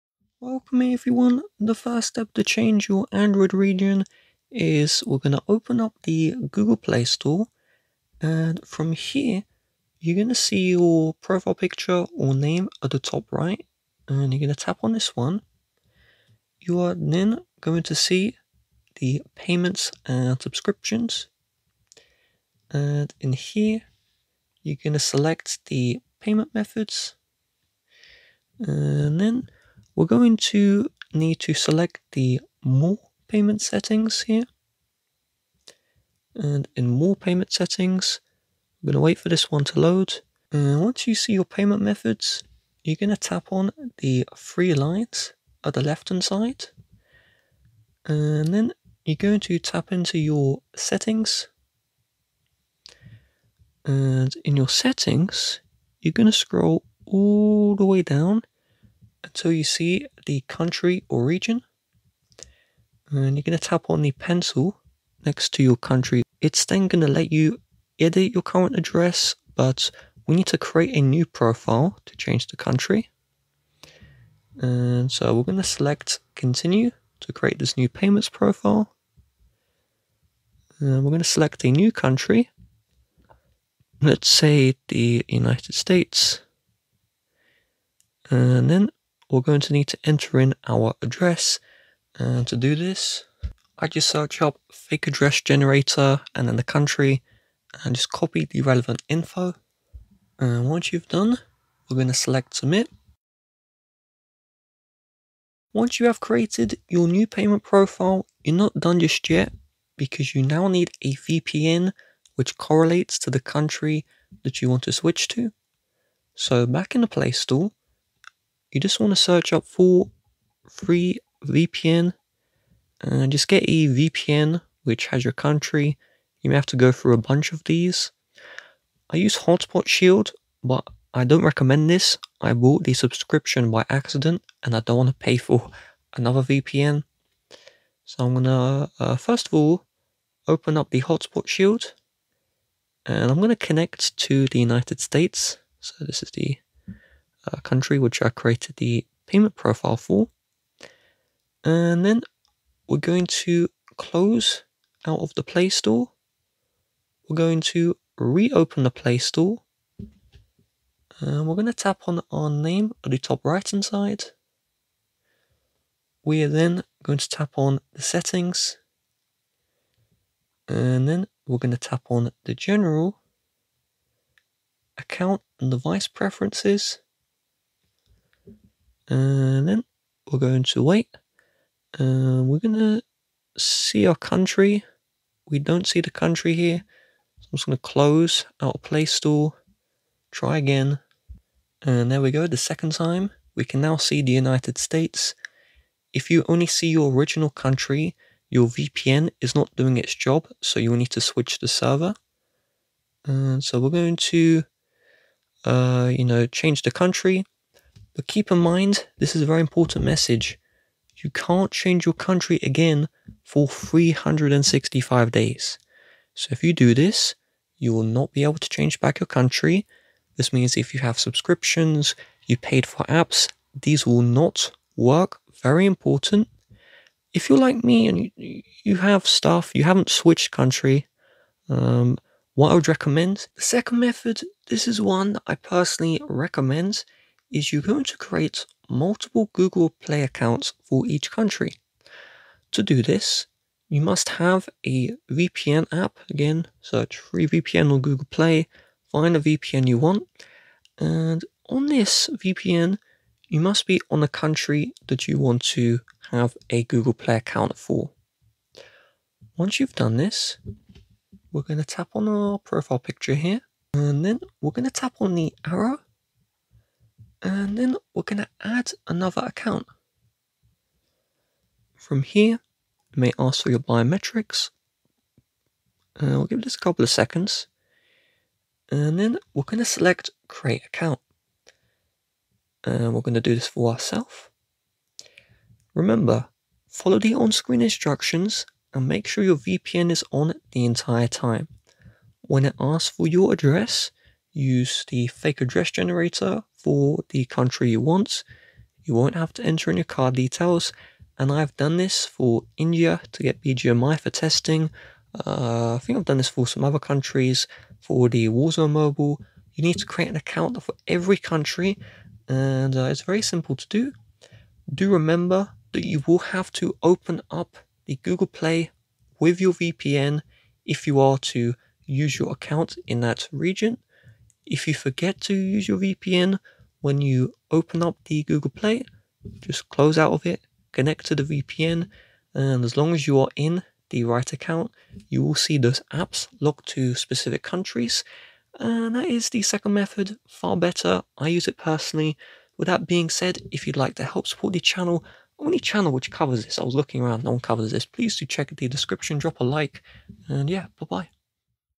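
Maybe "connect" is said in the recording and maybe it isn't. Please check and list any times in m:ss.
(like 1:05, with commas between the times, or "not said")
2:23, 5:30.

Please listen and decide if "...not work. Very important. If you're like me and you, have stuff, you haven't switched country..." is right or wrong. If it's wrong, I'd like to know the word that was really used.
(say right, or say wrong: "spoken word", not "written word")
right.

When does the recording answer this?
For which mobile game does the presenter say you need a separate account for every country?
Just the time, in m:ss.
5:08.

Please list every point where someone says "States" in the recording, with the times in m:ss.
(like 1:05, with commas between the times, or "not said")
1:25, 2:25, 3:14.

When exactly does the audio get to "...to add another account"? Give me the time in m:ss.
4:28.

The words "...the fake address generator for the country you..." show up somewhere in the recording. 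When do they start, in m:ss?
4:55.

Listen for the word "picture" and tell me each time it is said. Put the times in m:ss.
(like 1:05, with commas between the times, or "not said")
0:11, 4:22.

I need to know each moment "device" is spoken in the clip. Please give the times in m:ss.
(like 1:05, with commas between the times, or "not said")
2:55.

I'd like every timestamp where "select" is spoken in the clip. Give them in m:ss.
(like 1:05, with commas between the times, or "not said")
0:25, 0:31, 1:15, 1:21, 1:42, 4:39.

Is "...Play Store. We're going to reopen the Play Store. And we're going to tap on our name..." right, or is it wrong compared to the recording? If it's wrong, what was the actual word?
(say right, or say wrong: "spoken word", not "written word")
right.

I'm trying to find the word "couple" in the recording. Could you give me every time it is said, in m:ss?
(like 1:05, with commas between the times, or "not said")
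4:36.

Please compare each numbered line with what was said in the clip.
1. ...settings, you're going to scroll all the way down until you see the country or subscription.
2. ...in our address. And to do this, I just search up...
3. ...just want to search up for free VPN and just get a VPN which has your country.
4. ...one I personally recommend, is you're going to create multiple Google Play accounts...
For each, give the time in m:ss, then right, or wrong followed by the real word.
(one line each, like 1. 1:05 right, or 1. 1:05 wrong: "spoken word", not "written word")
1. 0:54 wrong: "region", not "subscription"
2. 1:30 right
3. 1:58 right
4. 3:54 right.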